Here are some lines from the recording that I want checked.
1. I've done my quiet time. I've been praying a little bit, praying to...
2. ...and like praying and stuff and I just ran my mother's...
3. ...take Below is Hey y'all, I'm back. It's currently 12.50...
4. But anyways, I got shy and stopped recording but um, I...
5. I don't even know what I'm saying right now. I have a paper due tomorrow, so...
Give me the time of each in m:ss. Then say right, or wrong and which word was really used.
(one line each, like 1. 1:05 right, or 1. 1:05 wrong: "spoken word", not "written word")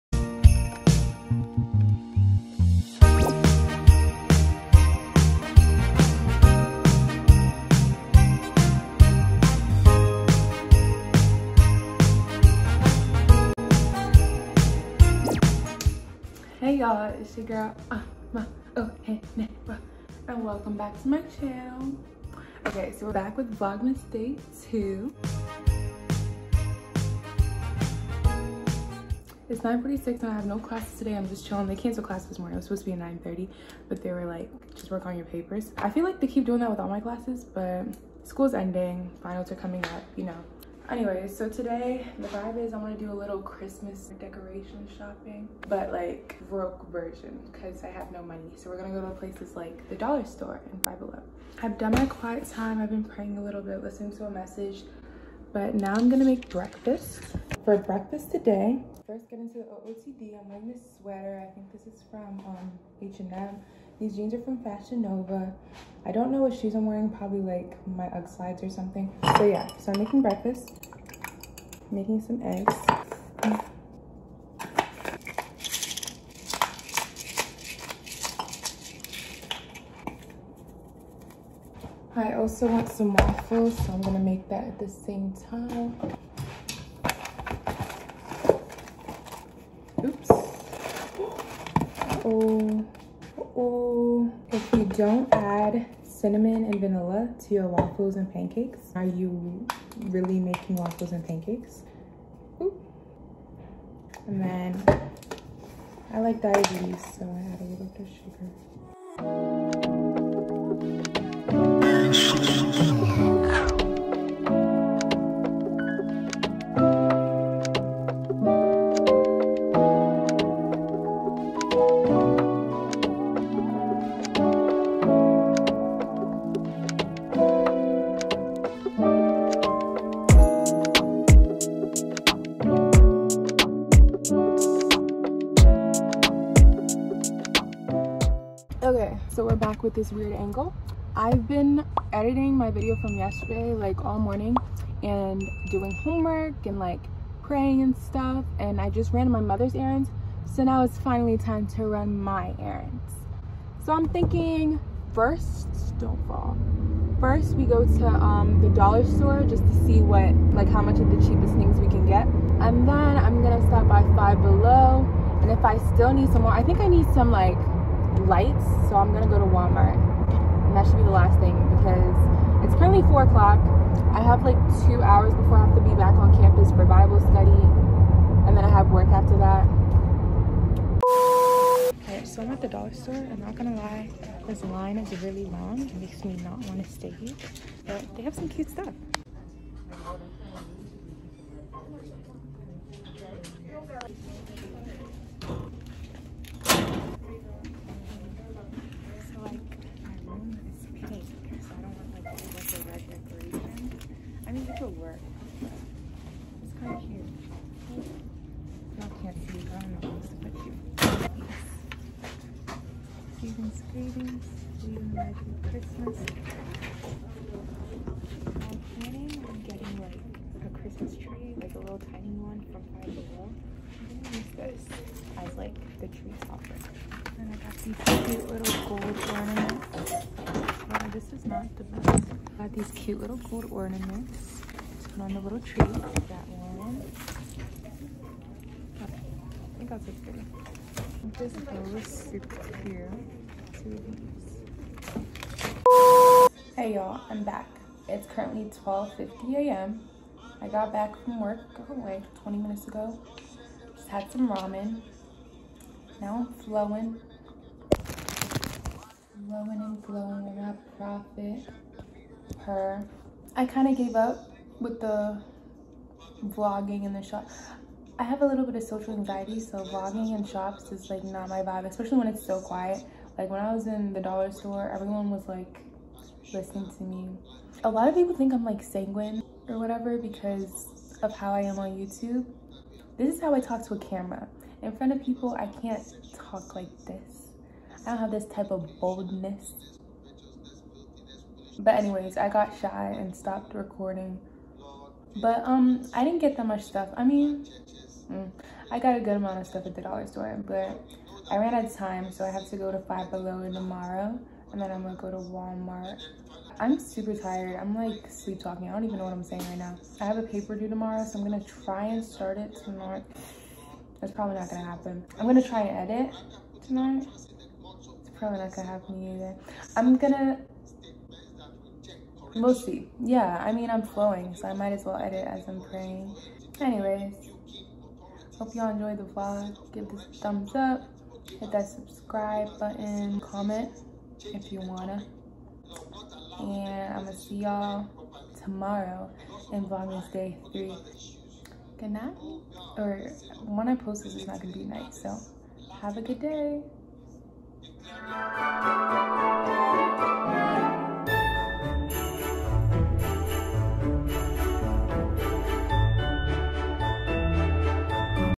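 1. 0:51 wrong: "listening", not "praying"
2. 2:26 right
3. 4:01 wrong: "This", not "Below"
4. 4:51 right
5. 5:08 right.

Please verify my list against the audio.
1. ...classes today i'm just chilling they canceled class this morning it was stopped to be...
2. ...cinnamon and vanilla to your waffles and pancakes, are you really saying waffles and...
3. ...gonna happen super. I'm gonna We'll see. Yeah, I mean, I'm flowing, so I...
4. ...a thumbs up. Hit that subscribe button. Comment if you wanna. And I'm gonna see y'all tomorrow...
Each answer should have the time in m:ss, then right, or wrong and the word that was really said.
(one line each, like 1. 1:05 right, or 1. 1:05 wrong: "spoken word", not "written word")
1. 0:30 wrong: "supposed", not "stopped"
2. 1:36 wrong: "making", not "saying"
3. 5:18 wrong: "either", not "super"
4. 5:30 right.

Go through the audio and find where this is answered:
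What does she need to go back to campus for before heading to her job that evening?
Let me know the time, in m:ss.
2:56.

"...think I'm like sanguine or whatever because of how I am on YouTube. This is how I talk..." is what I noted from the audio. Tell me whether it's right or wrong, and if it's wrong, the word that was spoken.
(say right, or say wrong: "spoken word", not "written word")
right.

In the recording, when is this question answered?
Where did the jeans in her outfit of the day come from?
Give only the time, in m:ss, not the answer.
1:04.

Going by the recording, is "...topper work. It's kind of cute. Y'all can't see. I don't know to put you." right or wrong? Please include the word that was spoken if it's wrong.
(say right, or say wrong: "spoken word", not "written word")
wrong: "paper", not "topper".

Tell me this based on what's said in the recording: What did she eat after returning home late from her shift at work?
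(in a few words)
ramen.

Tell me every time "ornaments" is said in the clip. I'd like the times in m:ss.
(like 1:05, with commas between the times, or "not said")
3:49, 3:53.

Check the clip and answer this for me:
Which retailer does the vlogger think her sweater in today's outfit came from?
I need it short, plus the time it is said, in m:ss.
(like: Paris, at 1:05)
H&M, at 1:03.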